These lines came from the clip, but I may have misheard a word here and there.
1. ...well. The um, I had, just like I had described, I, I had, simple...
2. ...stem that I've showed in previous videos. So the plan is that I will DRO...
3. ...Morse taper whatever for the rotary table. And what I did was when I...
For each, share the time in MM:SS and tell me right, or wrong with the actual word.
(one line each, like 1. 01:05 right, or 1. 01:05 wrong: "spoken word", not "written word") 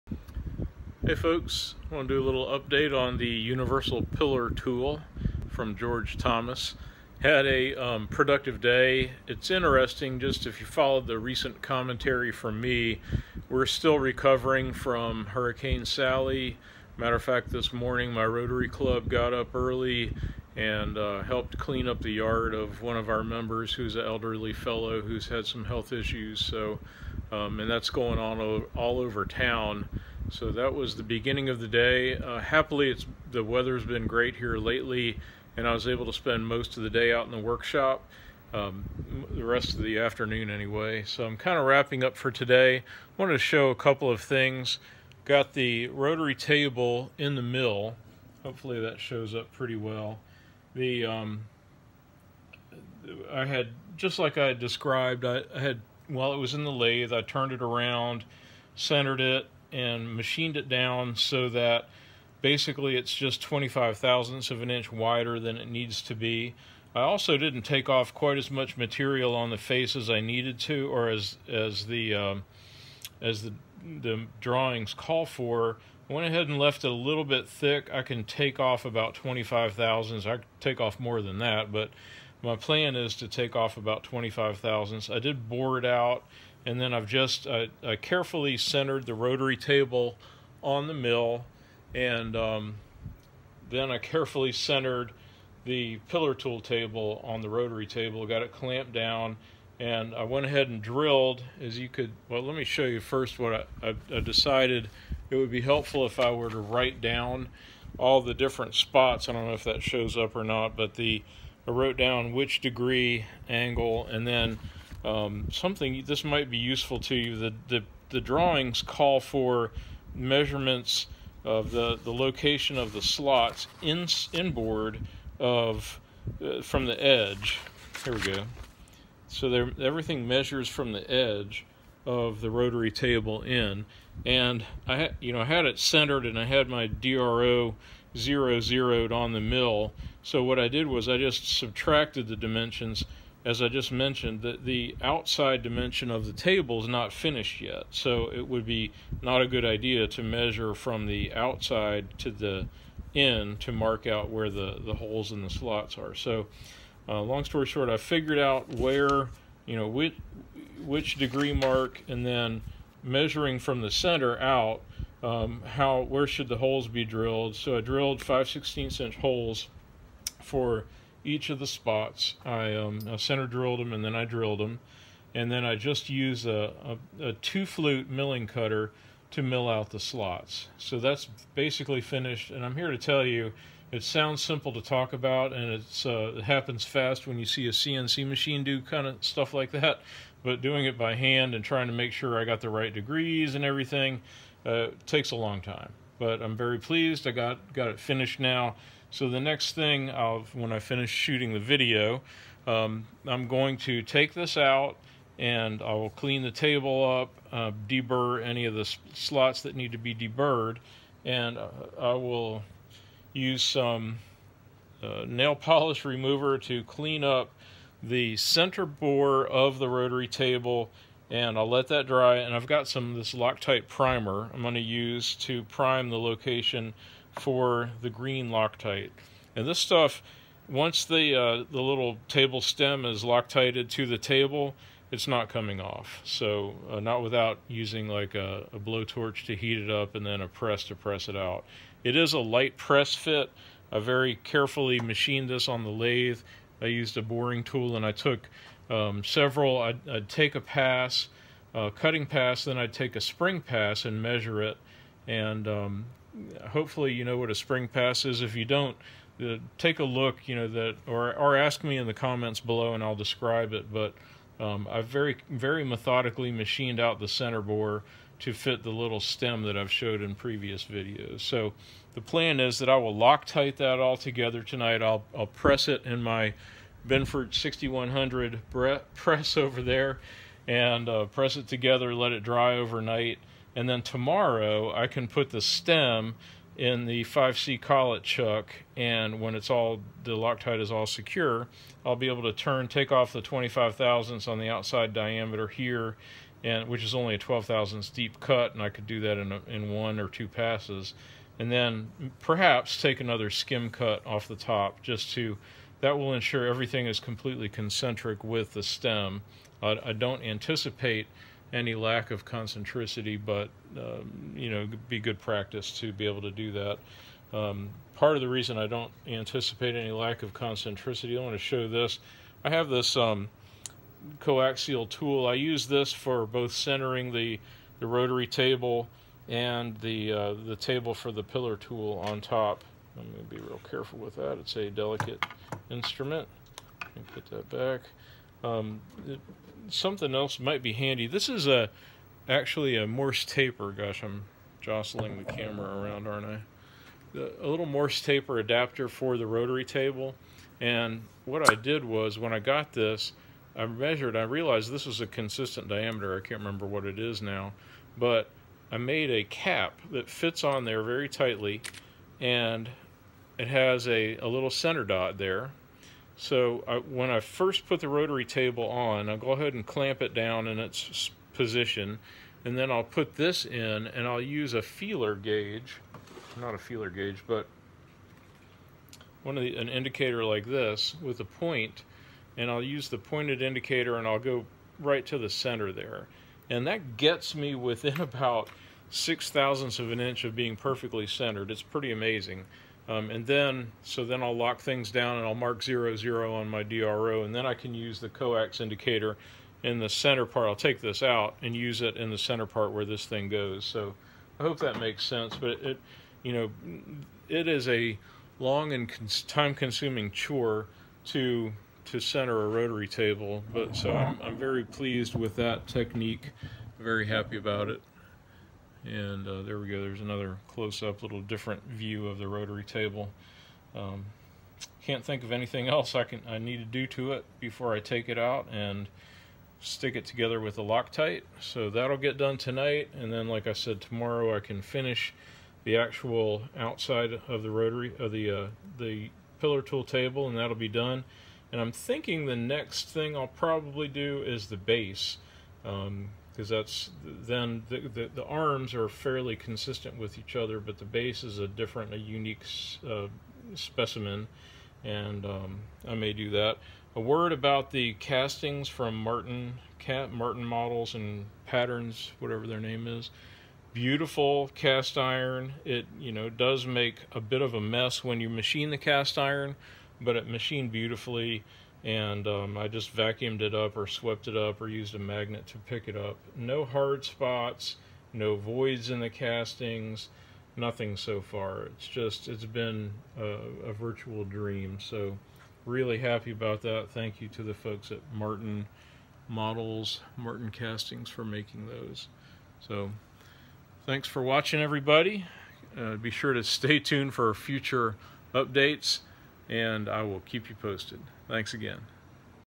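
1. 00:49 wrong: "while", not "simple"
2. 04:29 wrong: "Loctite", not "DRO"
3. 05:47 wrong: "adapter", not "whatever".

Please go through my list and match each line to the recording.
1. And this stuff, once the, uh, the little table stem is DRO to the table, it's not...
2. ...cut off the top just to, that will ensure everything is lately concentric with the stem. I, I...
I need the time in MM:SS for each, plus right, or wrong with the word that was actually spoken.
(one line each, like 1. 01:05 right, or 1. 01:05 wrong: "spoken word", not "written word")
1. 03:49 wrong: "Loctited", not "DRO"
2. 05:03 wrong: "completely", not "lately".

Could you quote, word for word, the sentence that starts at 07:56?
No hard spots, no voids in the castings, nothing so far.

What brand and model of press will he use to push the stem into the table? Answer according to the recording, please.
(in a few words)
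Benford 6100.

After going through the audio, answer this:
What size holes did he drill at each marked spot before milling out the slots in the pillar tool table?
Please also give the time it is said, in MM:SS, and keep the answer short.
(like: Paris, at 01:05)
5/16 inch, at 02:48.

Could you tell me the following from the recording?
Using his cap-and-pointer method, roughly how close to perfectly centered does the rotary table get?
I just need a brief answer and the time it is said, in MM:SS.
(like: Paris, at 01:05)
6 thousandths of an inch, at 06:29.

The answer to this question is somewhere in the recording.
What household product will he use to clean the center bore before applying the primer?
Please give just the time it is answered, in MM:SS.
03:35.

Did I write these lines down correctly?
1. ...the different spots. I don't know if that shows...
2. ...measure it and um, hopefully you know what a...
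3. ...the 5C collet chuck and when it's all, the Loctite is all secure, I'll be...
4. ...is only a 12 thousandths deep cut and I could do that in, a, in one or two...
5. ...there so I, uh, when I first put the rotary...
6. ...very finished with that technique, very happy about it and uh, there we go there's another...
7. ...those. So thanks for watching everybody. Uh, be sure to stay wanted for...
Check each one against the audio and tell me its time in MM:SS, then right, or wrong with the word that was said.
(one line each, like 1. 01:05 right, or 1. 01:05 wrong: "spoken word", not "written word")
1. 01:48 right
2. 04:14 right
3. 04:47 right
4. 04:57 right
5. 06:05 right
6. 06:54 wrong: "pleased", not "finished"
7. 08:11 wrong: "tuned", not "wanted".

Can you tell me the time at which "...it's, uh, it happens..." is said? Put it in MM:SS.
03:05.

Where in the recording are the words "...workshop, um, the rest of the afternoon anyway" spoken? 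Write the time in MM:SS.
00:37.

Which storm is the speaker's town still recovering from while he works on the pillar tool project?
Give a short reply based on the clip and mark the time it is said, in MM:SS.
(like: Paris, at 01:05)
Hurricane Sally, at 00:15.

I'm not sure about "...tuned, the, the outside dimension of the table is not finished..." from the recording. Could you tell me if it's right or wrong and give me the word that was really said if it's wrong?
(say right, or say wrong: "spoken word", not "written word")
wrong: "mentioned", not "tuned".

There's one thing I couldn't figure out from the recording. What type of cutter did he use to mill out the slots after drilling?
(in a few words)
two flute milling cutter.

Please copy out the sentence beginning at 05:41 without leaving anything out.
This is a actually a Morse taper.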